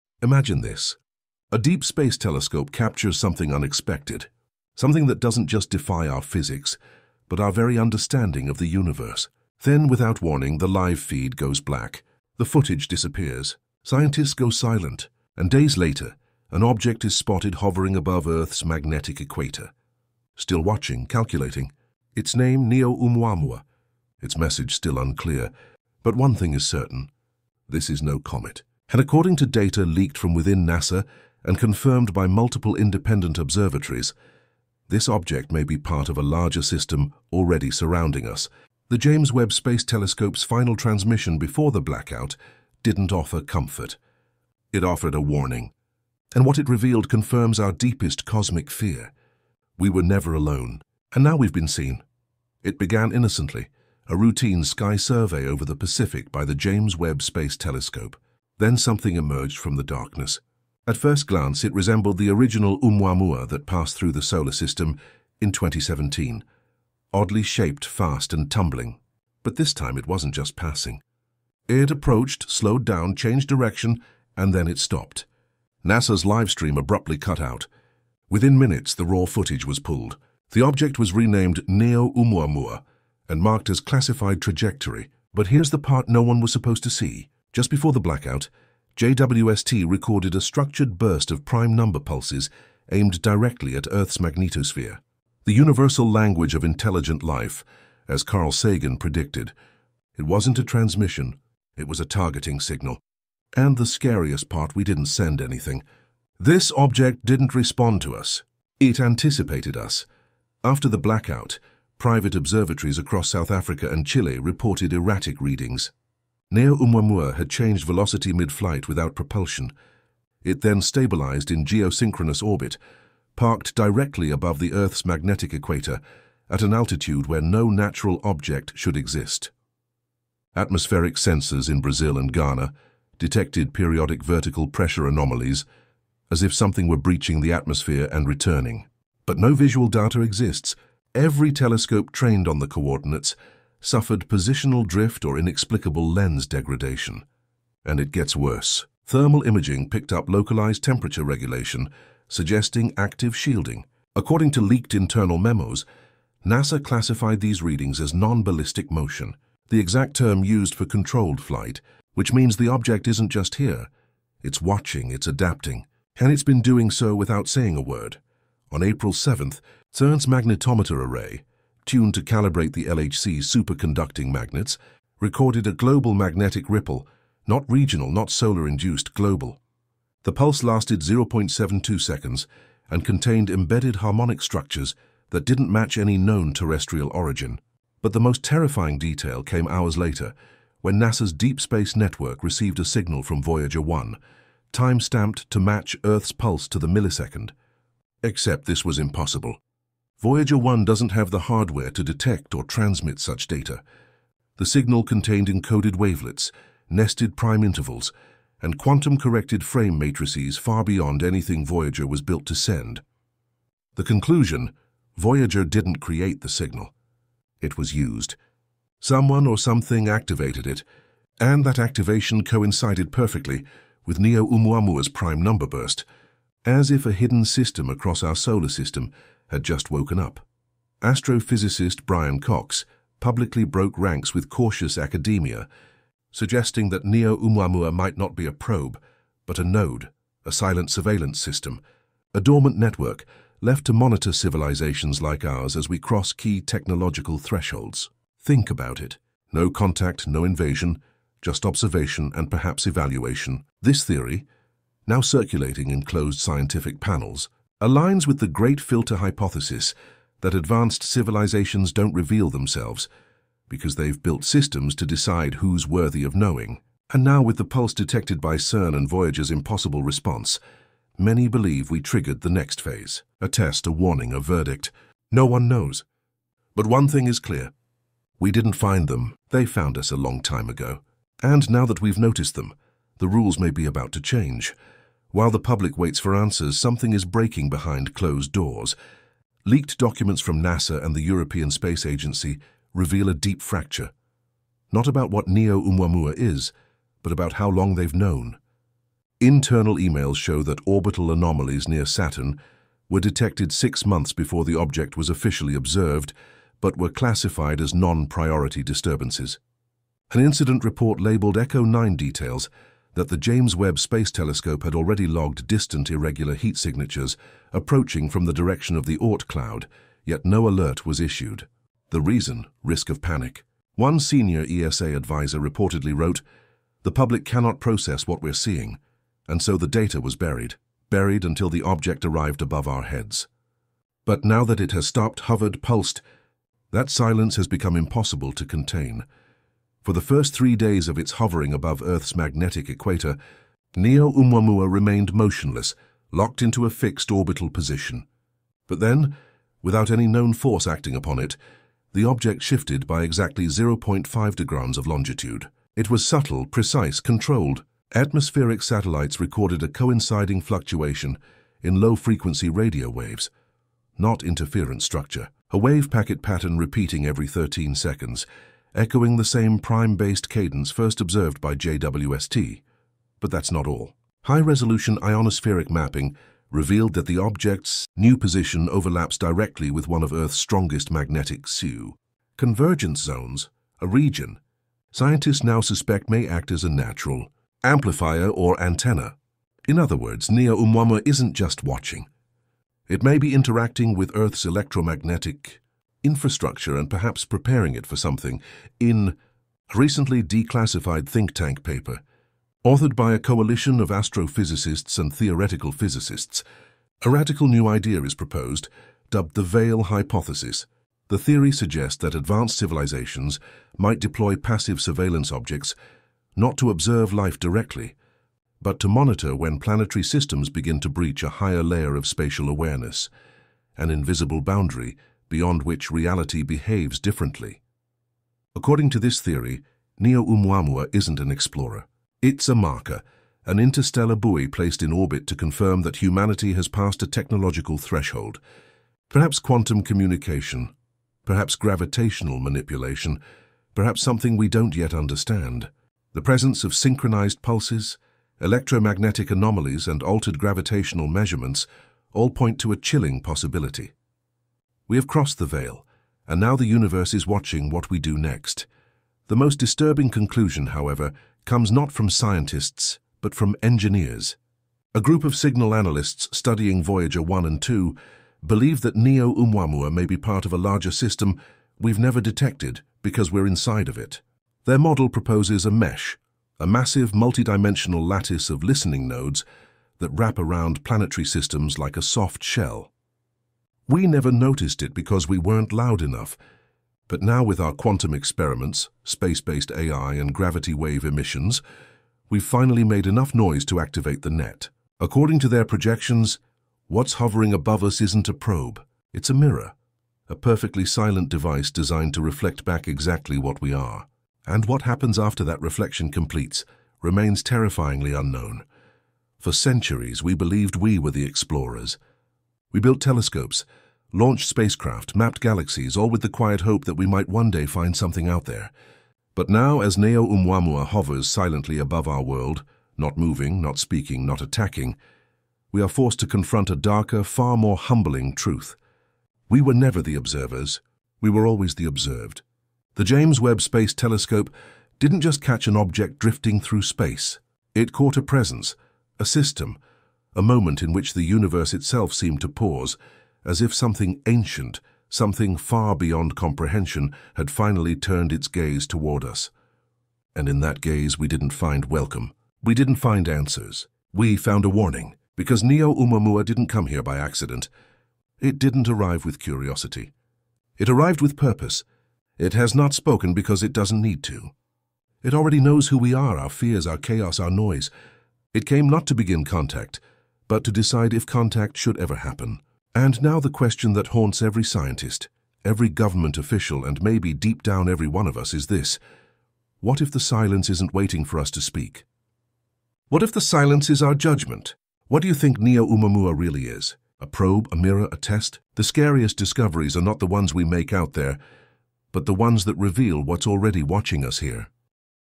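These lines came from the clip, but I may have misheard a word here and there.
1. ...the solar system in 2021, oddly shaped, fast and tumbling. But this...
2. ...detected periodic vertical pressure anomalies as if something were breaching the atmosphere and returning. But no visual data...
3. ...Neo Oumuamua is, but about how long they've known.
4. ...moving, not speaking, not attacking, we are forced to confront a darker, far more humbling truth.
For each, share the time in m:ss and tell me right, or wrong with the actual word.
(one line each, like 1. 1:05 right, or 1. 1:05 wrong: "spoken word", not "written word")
1. 1:04 wrong: "2017", not "2021"
2. 2:13 right
3. 4:55 right
4. 8:43 right.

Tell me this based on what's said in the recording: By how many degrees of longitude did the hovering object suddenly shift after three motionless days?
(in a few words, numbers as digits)
0.5 degrees.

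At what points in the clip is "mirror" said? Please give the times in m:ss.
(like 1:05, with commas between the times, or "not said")
8:19, 9:47.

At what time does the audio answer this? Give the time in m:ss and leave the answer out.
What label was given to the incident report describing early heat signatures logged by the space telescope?
5:11.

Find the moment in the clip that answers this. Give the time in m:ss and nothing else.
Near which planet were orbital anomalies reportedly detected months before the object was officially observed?
5:02.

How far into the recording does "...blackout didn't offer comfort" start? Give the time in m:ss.
0:41.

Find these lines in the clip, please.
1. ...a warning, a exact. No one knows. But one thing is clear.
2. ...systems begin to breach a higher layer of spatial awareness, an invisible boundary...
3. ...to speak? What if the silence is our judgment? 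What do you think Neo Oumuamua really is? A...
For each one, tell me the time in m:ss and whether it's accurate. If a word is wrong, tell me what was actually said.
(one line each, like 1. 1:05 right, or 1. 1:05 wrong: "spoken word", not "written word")
1. 4:33 wrong: "verdict", not "exact"
2. 7:00 right
3. 9:41 right.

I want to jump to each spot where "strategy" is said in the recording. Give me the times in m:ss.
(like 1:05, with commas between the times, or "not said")
not said.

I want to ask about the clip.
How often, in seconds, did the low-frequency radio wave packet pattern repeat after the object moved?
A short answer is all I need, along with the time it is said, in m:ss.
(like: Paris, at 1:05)
13 seconds, at 6:07.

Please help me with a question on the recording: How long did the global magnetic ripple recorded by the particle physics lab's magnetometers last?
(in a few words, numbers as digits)
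0.72 seconds.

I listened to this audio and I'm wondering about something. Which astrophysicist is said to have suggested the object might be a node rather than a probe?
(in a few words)
Brian Cox.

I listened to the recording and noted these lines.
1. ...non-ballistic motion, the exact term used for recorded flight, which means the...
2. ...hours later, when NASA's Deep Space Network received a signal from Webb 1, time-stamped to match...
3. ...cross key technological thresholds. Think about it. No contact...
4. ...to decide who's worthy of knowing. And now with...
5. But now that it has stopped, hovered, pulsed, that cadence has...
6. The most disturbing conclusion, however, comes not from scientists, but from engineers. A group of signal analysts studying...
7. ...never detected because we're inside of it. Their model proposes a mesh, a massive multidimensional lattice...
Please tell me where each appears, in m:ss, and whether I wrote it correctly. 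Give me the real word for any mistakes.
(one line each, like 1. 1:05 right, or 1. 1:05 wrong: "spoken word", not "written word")
1. 2:38 wrong: "controlled", not "recorded"
2. 3:09 wrong: "Voyager", not "Webb"
3. 4:05 right
4. 4:24 right
5. 5:34 wrong: "silence", not "cadence"
6. 7:39 right
7. 7:52 right.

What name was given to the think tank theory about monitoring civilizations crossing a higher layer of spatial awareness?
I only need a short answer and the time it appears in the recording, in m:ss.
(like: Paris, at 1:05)
Veil Hypothesis, at 6:49.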